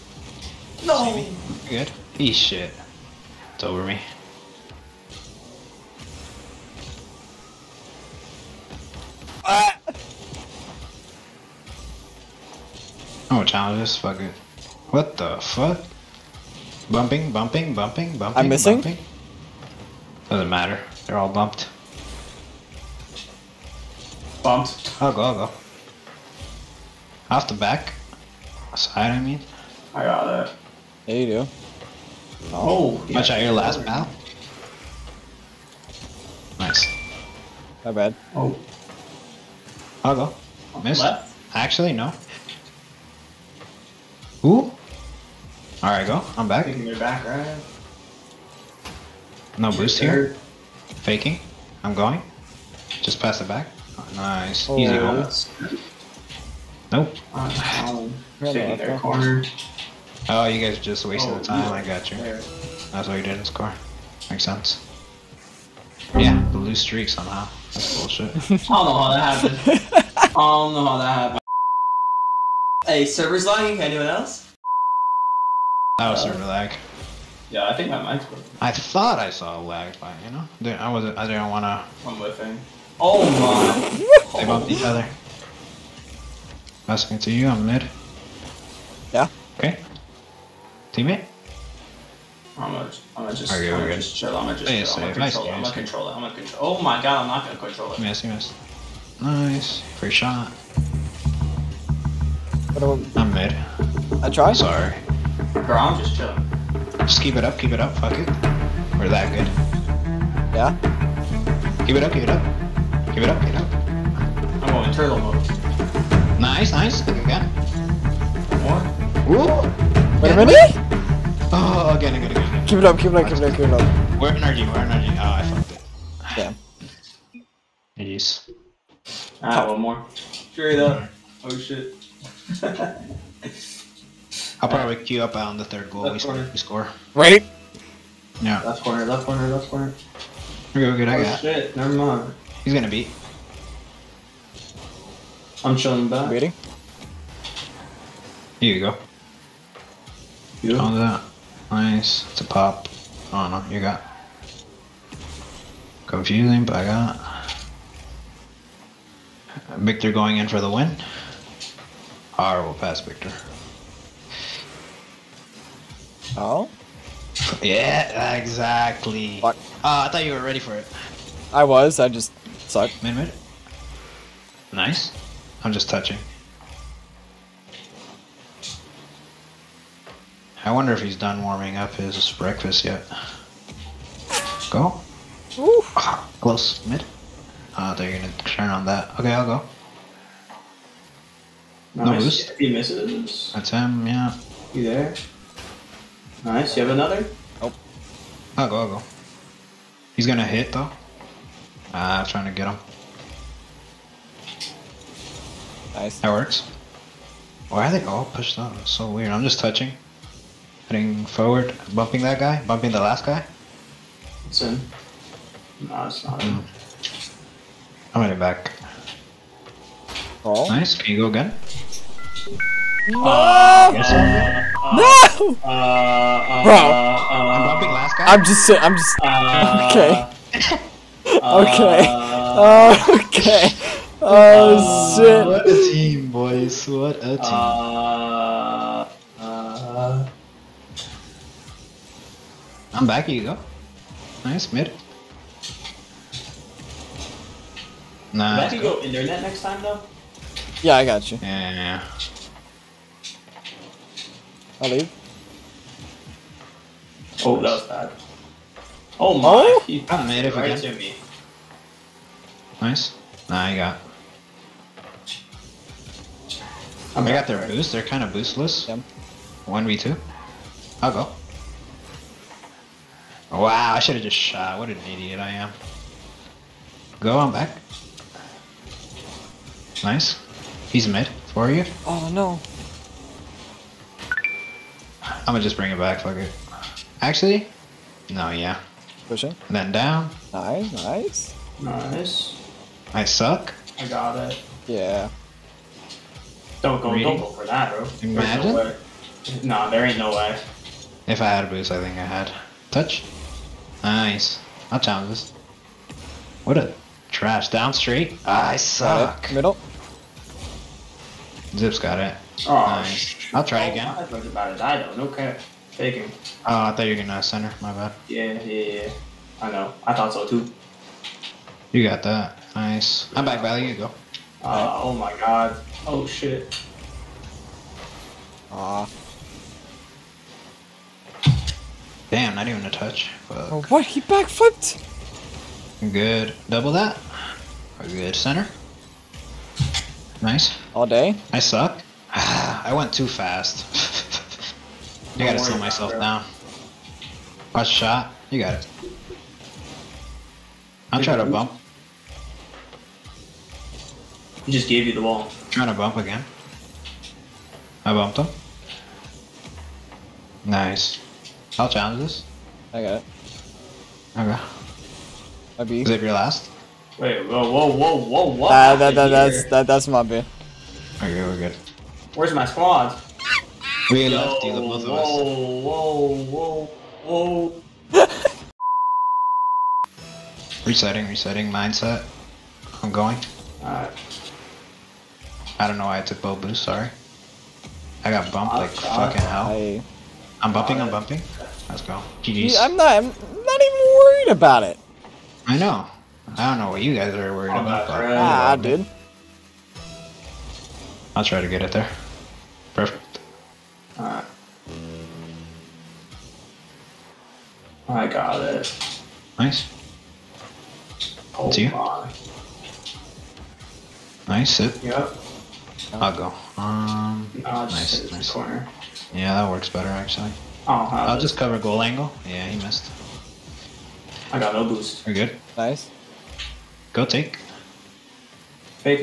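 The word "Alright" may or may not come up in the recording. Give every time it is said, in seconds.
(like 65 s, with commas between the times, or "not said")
129 s, 383 s, 404 s.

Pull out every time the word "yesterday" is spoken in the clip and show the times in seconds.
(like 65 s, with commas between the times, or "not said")
not said.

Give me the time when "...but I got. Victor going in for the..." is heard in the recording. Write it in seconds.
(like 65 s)
156 s.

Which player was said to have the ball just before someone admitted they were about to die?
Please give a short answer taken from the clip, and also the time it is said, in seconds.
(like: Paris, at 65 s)
Zip, at 311 s.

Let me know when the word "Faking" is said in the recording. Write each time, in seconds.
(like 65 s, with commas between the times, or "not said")
51 s, 315 s.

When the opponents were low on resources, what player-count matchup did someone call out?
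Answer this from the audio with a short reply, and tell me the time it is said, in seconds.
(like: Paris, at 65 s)
One v two, at 269 s.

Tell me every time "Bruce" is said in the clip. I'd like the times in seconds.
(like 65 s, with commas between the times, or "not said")
49 s.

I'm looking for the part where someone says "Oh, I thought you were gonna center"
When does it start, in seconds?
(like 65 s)
316 s.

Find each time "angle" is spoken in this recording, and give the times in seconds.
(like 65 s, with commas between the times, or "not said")
422 s.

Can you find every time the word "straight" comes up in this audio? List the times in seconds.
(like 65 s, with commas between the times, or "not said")
130 s, 307 s.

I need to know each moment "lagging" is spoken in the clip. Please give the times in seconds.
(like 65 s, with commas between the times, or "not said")
73 s.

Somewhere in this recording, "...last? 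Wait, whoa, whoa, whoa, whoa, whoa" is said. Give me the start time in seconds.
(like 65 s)
366 s.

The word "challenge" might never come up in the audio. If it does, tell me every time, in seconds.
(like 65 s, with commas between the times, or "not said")
13 s, 304 s, 361 s.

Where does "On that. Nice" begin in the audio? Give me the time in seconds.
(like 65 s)
150 s.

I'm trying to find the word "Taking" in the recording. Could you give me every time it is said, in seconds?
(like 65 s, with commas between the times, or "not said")
46 s.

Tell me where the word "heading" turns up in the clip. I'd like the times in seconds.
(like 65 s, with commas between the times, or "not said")
210 s, 218 s.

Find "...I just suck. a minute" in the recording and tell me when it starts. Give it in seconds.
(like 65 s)
171 s.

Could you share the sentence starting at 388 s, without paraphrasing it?
I got bumped like fucking hell.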